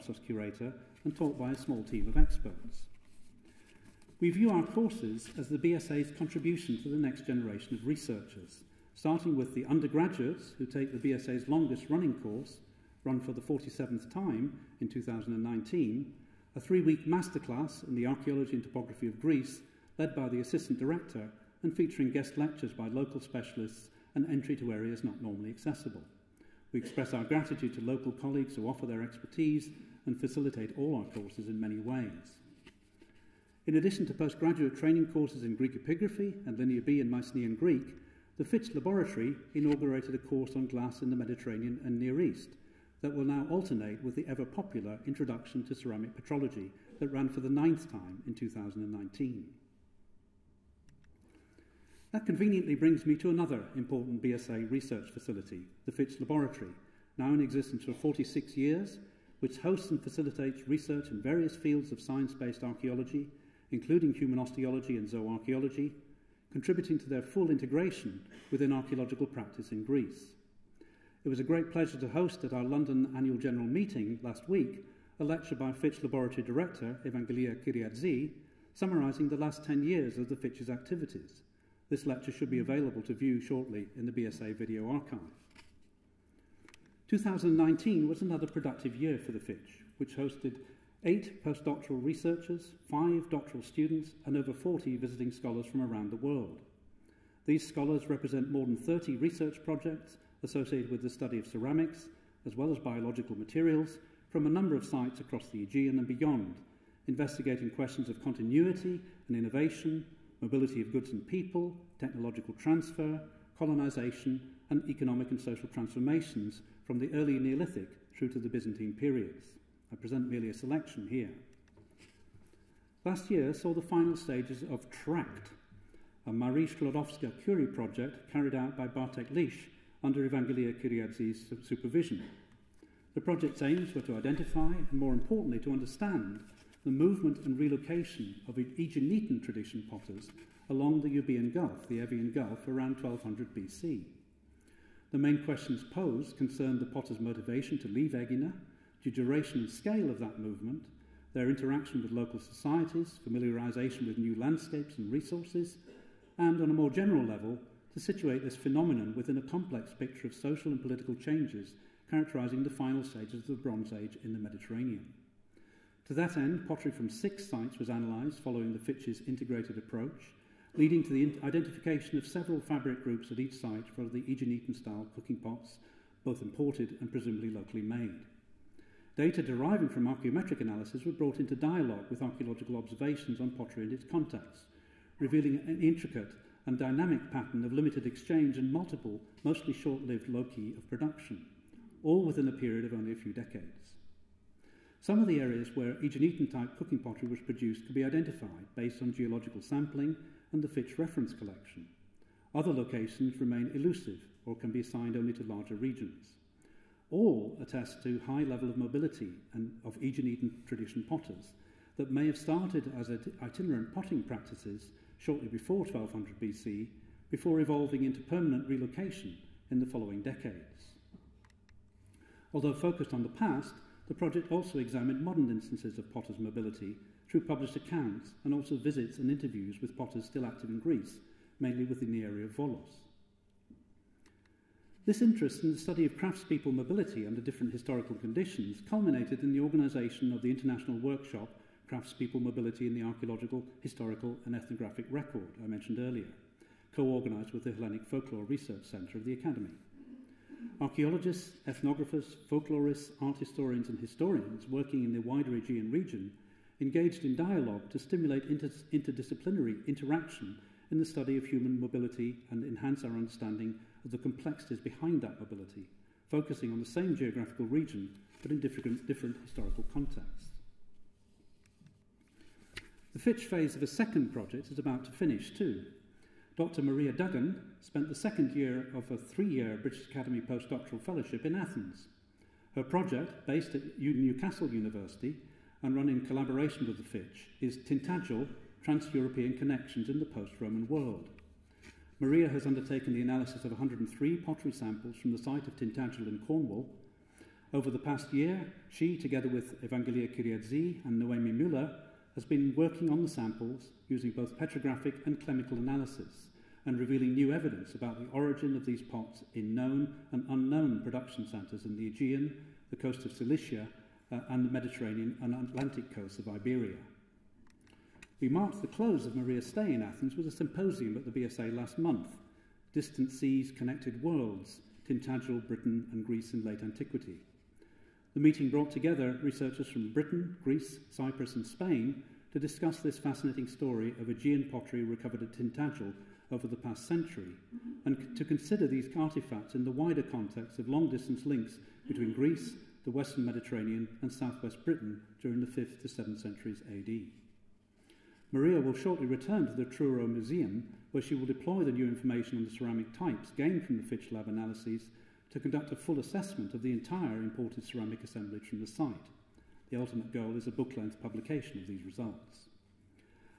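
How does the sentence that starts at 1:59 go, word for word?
I present merely a selection here.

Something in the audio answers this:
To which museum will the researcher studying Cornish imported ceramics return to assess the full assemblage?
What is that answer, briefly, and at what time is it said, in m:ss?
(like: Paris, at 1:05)
Truro Museum, at 5:49.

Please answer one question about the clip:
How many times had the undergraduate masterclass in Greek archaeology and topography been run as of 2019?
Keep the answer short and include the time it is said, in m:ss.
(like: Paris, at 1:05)
47, at 0:13.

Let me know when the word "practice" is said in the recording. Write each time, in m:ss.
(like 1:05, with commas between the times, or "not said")
1:09, 3:34.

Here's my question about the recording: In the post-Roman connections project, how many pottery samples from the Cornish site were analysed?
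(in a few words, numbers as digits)
103.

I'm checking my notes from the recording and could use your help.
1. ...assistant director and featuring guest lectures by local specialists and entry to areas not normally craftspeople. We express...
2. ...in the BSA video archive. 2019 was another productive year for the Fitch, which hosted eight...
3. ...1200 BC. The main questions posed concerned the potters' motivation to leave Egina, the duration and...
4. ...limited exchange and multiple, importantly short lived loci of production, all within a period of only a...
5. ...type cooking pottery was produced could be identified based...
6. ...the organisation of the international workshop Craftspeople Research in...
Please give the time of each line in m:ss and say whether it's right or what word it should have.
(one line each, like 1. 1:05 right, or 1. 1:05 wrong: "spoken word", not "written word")
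1. 0:20 wrong: "accessible", not "craftspeople"
2. 1:23 right
3. 2:23 right
4. 3:07 wrong: "mostly", not "importantly"
5. 3:16 right
6. 3:59 wrong: "Mobility", not "Research".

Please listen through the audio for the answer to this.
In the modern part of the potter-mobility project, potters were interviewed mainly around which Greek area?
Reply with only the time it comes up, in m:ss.
3:52.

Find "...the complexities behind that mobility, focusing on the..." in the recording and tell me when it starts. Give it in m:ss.
4:24.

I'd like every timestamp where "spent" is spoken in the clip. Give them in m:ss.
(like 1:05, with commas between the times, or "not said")
4:37.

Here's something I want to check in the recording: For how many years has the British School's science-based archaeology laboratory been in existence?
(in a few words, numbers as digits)
46 years.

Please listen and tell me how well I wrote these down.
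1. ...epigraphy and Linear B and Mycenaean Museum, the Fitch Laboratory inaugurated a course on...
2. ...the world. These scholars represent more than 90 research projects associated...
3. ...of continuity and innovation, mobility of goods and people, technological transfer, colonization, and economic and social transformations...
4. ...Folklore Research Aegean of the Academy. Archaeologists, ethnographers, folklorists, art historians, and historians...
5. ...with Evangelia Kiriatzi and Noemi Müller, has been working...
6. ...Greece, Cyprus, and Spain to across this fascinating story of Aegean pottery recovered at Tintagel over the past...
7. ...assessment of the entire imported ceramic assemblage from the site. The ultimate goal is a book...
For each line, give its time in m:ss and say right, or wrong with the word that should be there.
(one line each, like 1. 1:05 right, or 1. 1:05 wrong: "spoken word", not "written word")
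1. 0:35 wrong: "Greek", not "Museum"
2. 1:36 wrong: "30", not "90"
3. 1:48 right
4. 4:08 wrong: "Centre", not "Aegean"
5. 4:59 right
6. 5:30 wrong: "discuss", not "across"
7. 5:56 right.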